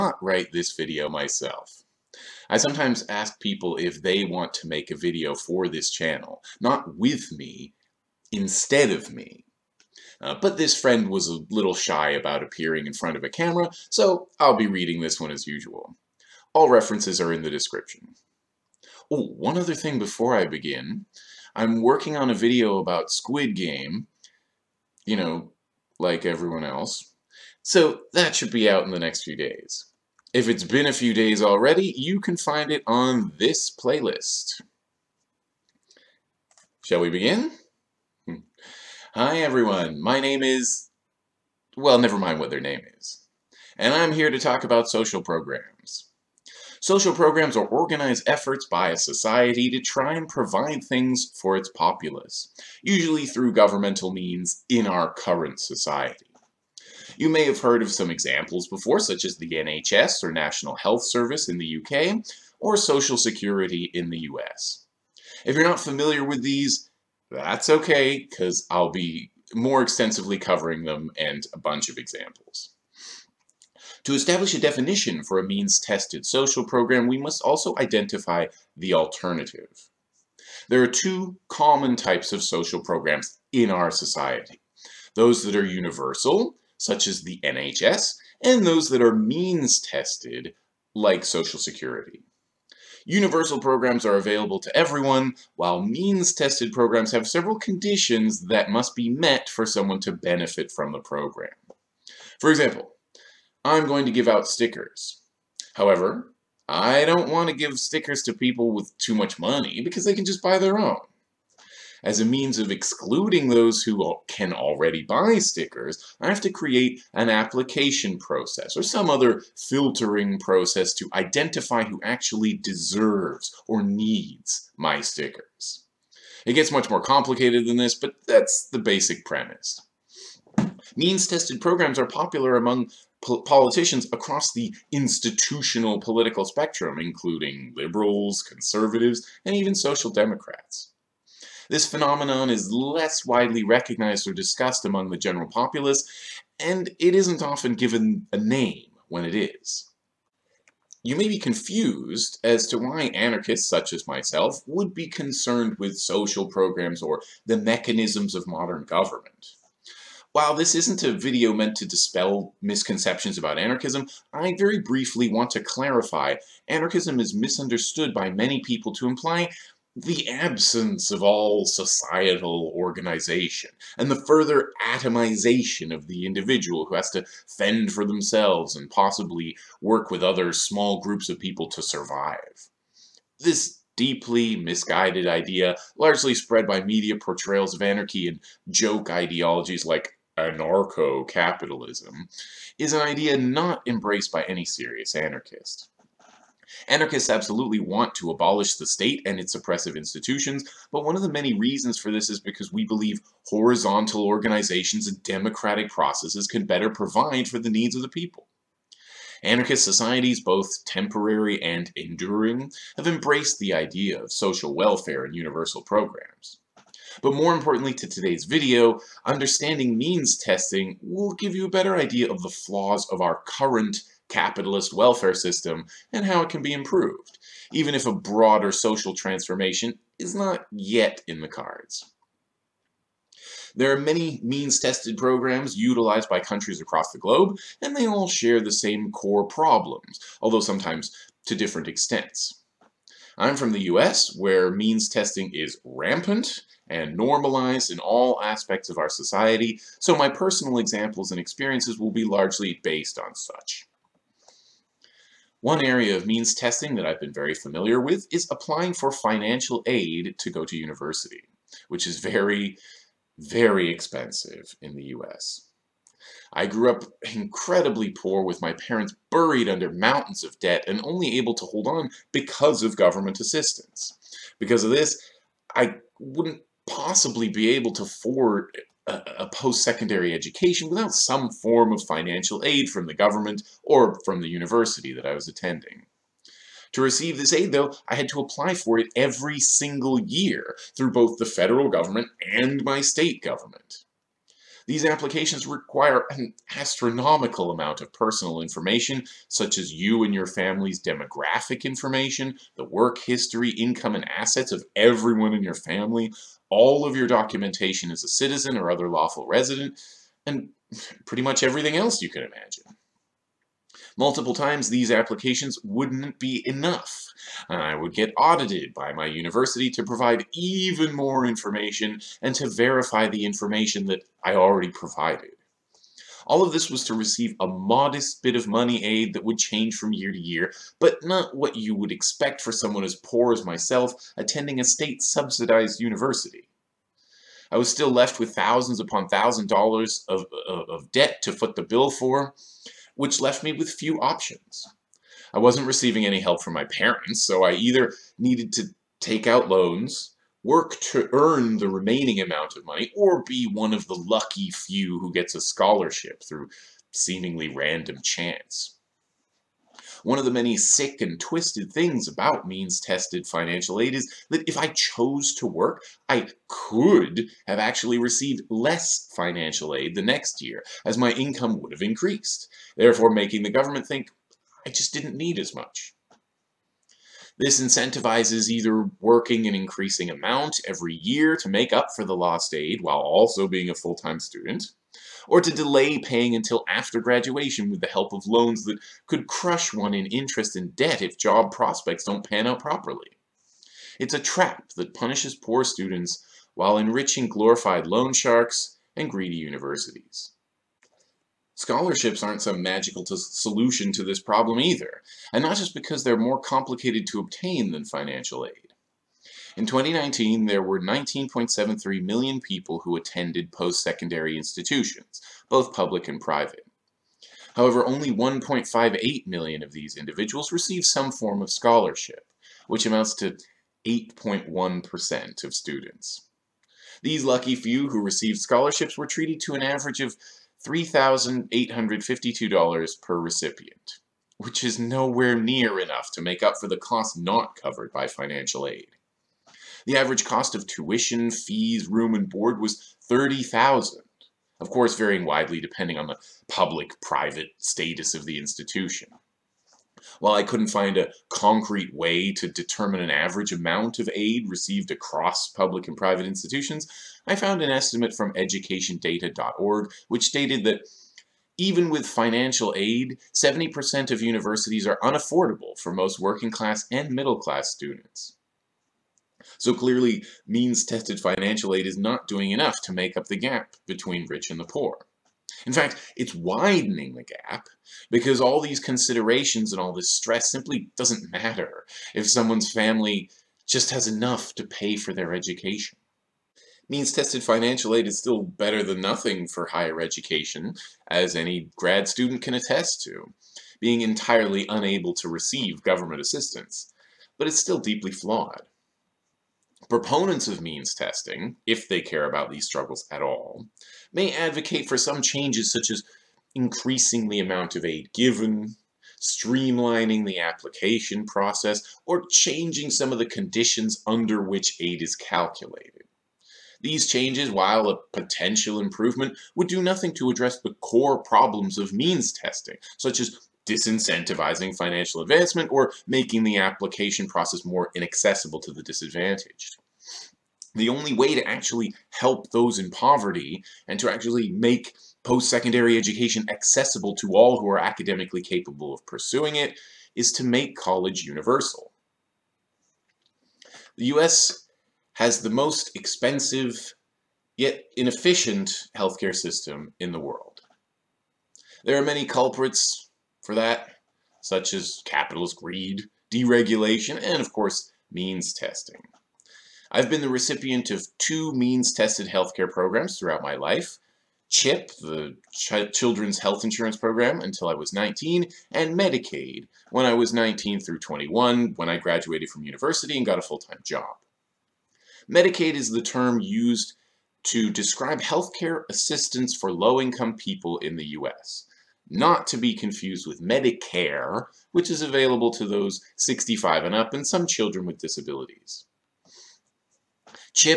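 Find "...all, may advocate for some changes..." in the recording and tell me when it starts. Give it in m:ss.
8:23.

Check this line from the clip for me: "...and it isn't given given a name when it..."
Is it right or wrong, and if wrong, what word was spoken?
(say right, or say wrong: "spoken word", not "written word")
wrong: "often", not "given".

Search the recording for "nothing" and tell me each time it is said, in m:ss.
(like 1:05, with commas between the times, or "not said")
8:09, 8:40.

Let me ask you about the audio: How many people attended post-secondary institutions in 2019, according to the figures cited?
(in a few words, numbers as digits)
19.73 million.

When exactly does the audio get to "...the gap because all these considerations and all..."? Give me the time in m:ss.
7:57.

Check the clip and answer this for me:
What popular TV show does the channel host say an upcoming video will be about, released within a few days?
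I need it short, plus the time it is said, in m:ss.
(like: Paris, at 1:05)
Squid Game, at 0:23.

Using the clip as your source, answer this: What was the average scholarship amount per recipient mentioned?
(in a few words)
$3,852.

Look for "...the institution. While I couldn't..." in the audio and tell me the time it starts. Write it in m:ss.
7:28.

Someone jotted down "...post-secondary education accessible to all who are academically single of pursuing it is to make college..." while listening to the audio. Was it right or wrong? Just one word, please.
wrong.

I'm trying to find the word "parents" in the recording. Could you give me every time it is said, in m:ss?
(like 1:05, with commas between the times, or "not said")
4:28, 5:46.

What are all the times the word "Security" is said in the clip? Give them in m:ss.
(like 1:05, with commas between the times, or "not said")
1:03, 1:31.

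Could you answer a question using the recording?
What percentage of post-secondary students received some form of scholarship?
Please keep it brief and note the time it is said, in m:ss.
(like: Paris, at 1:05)
8.1%, at 7:04.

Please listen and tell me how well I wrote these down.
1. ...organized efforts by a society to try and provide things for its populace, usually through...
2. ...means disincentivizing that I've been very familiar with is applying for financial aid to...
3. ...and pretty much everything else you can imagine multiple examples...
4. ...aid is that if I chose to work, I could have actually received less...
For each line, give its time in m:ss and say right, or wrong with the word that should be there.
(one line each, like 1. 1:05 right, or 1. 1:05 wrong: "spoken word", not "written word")
1. 0:47 right
2. 4:16 wrong: "testing", not "disincentivizing"
3. 5:10 wrong: "times", not "examples"
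4. 6:04 right.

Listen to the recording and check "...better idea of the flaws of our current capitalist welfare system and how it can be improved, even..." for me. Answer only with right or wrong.
right.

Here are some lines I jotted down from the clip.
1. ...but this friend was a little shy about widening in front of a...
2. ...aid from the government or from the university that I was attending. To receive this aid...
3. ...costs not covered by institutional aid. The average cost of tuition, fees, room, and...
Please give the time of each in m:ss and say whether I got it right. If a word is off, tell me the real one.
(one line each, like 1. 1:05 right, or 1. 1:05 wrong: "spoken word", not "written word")
1. 0:10 wrong: "appearing", not "widening"
2. 4:42 right
3. 7:16 wrong: "financial", not "institutional".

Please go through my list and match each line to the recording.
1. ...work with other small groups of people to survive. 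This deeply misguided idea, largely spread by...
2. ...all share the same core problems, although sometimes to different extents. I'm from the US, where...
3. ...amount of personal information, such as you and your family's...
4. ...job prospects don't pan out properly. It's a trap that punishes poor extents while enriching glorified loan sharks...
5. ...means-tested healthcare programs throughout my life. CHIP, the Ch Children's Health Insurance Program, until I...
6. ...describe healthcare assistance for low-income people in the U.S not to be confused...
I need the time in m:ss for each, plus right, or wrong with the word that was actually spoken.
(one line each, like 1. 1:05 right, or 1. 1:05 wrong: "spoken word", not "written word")
1. 2:59 right
2. 3:58 right
3. 4:57 right
4. 6:31 wrong: "students", not "extents"
5. 9:21 right
6. 9:37 right.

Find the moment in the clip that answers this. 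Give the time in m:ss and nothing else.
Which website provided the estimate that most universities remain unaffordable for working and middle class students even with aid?
7:38.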